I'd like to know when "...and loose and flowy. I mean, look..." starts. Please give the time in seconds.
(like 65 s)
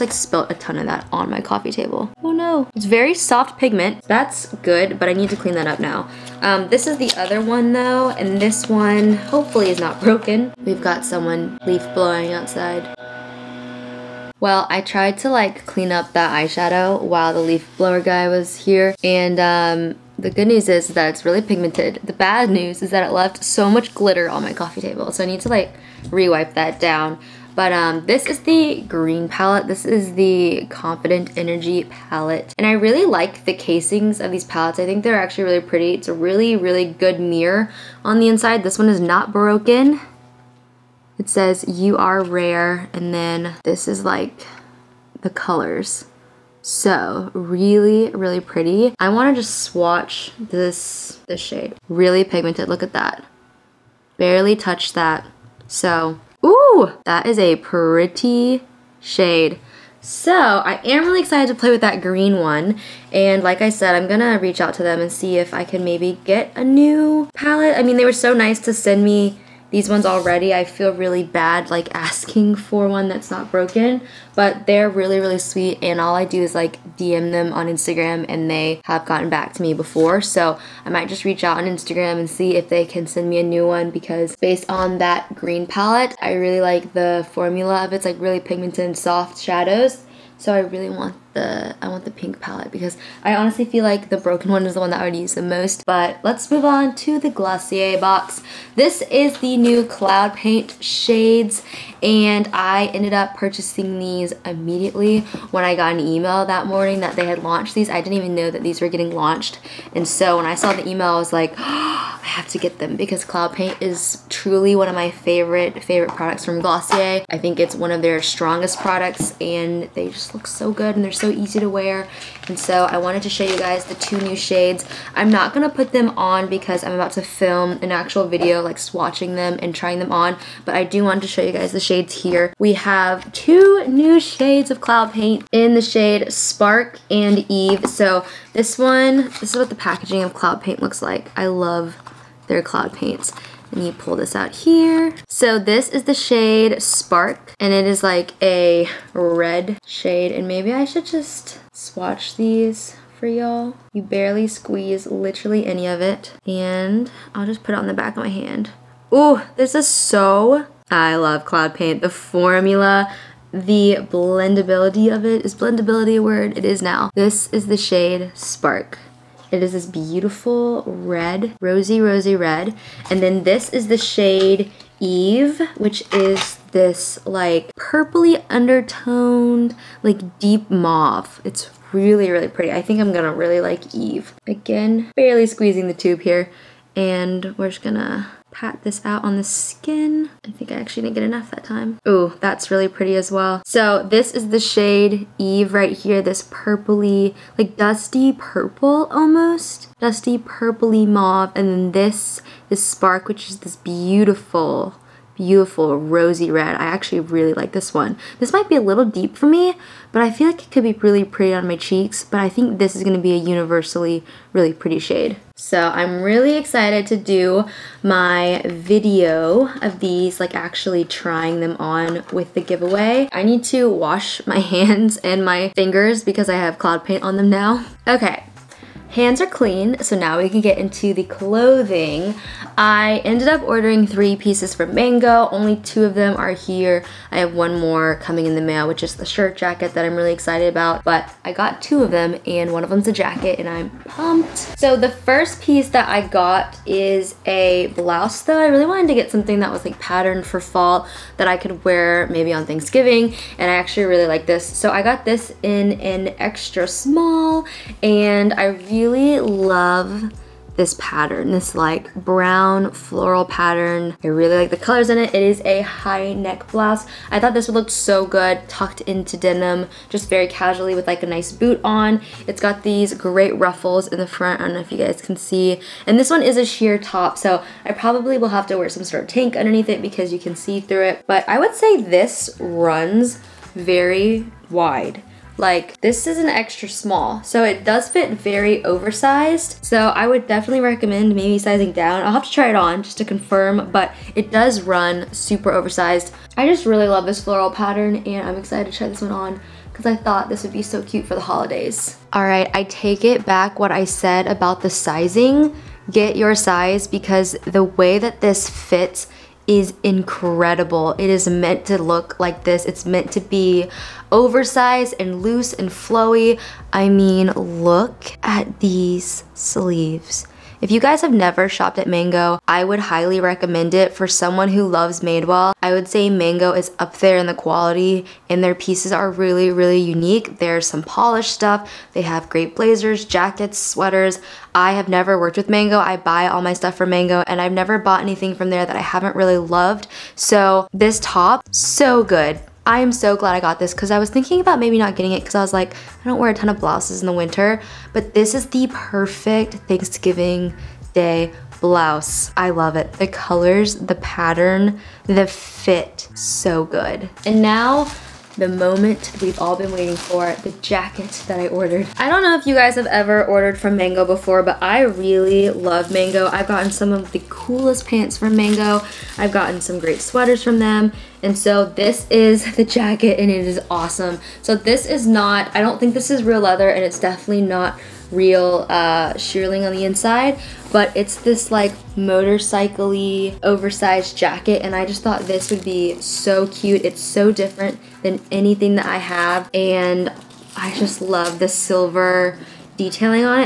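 315 s.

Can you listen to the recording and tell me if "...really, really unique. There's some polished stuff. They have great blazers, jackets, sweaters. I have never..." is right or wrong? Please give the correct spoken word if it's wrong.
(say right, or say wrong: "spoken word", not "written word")
right.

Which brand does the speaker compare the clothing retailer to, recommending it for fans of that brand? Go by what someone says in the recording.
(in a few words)
Madewell.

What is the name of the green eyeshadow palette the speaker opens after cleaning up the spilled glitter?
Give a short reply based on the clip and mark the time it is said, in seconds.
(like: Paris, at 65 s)
Confident Energy, at 30 s.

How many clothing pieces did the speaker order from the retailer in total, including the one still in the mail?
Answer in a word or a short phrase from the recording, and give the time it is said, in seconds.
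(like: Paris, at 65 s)
3, at 234 s.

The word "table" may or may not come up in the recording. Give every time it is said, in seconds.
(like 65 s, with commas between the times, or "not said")
1 s, 24 s.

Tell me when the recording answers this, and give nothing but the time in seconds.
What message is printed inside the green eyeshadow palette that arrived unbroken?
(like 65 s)
41 s.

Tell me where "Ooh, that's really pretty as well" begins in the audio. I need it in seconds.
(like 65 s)
192 s.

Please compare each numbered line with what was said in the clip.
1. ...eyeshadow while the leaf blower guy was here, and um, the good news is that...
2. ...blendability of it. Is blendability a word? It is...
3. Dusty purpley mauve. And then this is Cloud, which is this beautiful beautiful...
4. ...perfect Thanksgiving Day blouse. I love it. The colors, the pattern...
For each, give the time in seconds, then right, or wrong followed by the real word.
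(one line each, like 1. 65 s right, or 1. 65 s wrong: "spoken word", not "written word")
1. 16 s right
2. 164 s right
3. 200 s wrong: "Spark", not "Cloud"
4. 348 s right.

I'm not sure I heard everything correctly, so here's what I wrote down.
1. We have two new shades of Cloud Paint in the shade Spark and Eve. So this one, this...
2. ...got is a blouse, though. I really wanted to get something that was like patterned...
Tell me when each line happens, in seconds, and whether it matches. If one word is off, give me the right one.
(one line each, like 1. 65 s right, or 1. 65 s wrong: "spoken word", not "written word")
1. 132 s right
2. 246 s right.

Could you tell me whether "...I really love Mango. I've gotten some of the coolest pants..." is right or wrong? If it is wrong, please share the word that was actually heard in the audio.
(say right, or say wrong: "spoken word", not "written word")
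right.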